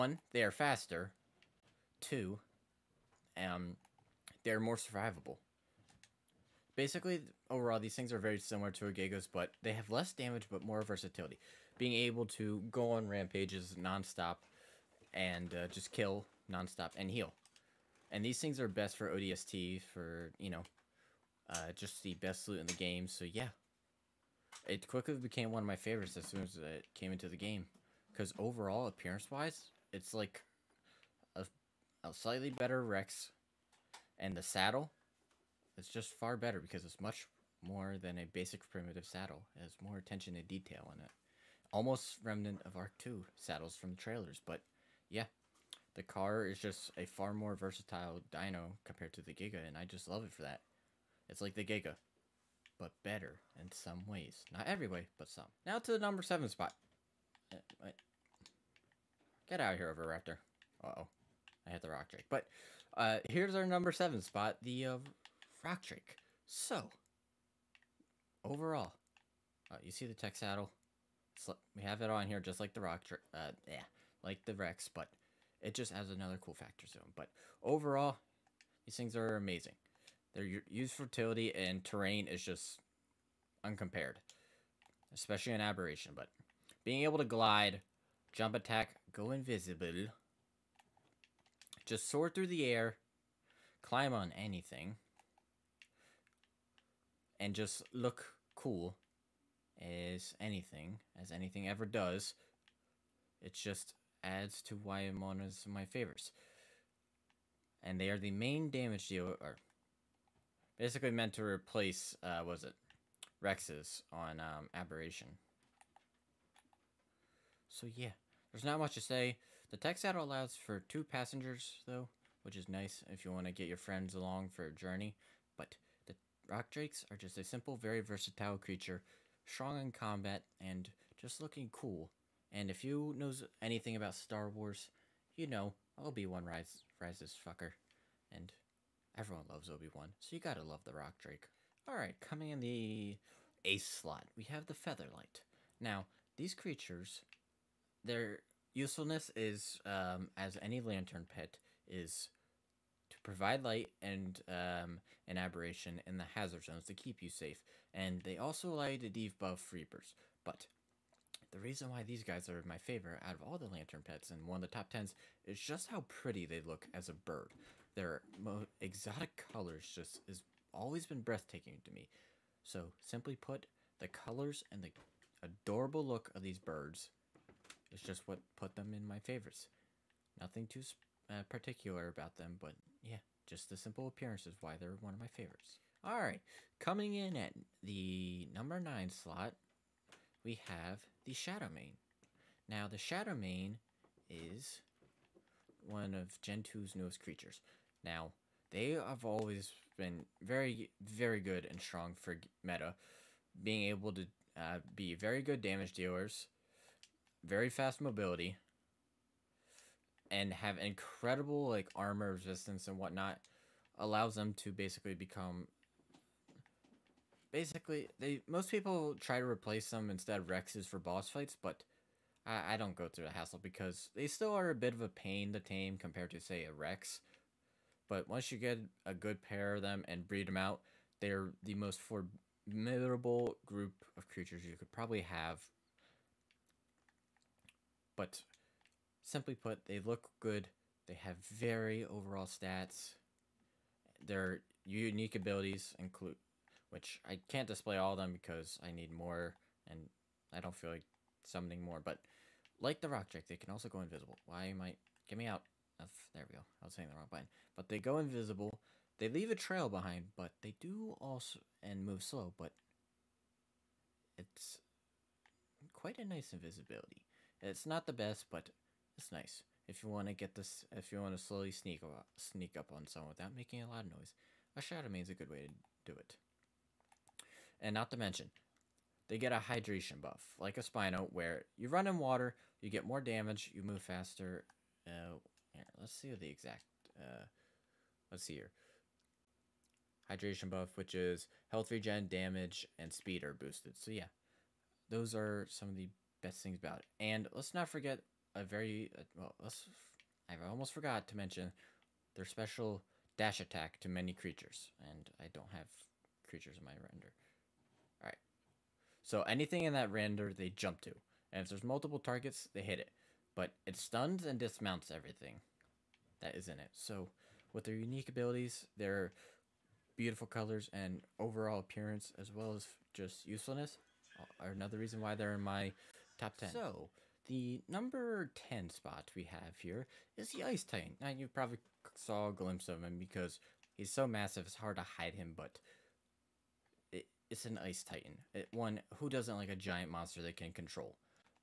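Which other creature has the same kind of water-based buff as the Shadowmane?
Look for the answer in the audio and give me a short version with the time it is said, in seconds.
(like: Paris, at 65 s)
Spino, at 280 s.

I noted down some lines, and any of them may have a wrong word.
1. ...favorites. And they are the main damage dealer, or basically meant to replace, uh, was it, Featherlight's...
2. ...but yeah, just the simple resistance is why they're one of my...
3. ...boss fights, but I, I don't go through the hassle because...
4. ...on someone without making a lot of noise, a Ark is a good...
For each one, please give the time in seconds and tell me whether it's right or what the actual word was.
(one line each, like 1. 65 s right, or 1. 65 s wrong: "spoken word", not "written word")
1. 105 s wrong: "Rex", not "Featherlight"
2. 182 s wrong: "appearance", not "resistance"
3. 220 s right
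4. 272 s wrong: "Shadowmane", not "Ark".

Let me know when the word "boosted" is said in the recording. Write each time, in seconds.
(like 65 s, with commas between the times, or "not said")
293 s.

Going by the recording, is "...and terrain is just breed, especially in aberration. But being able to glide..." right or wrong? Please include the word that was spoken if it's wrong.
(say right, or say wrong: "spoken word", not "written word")
wrong: "uncompared", not "breed".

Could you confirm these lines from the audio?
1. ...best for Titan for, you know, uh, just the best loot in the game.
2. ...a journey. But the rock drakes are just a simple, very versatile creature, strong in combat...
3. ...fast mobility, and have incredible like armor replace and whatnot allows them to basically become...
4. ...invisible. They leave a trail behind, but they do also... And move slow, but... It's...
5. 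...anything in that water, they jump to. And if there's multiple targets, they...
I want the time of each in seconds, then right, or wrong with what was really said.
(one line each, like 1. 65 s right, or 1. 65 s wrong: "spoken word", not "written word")
1. 18 s wrong: "ODST", not "Titan"
2. 124 s right
3. 207 s wrong: "resistance", not "replace"
4. 258 s right
5. 309 s wrong: "render", not "water".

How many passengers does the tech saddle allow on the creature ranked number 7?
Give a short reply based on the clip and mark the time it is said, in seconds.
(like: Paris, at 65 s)
2, at 120 s.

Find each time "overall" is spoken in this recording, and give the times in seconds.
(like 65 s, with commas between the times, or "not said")
7 s, 28 s, 68 s, 77 s, 242 s, 321 s.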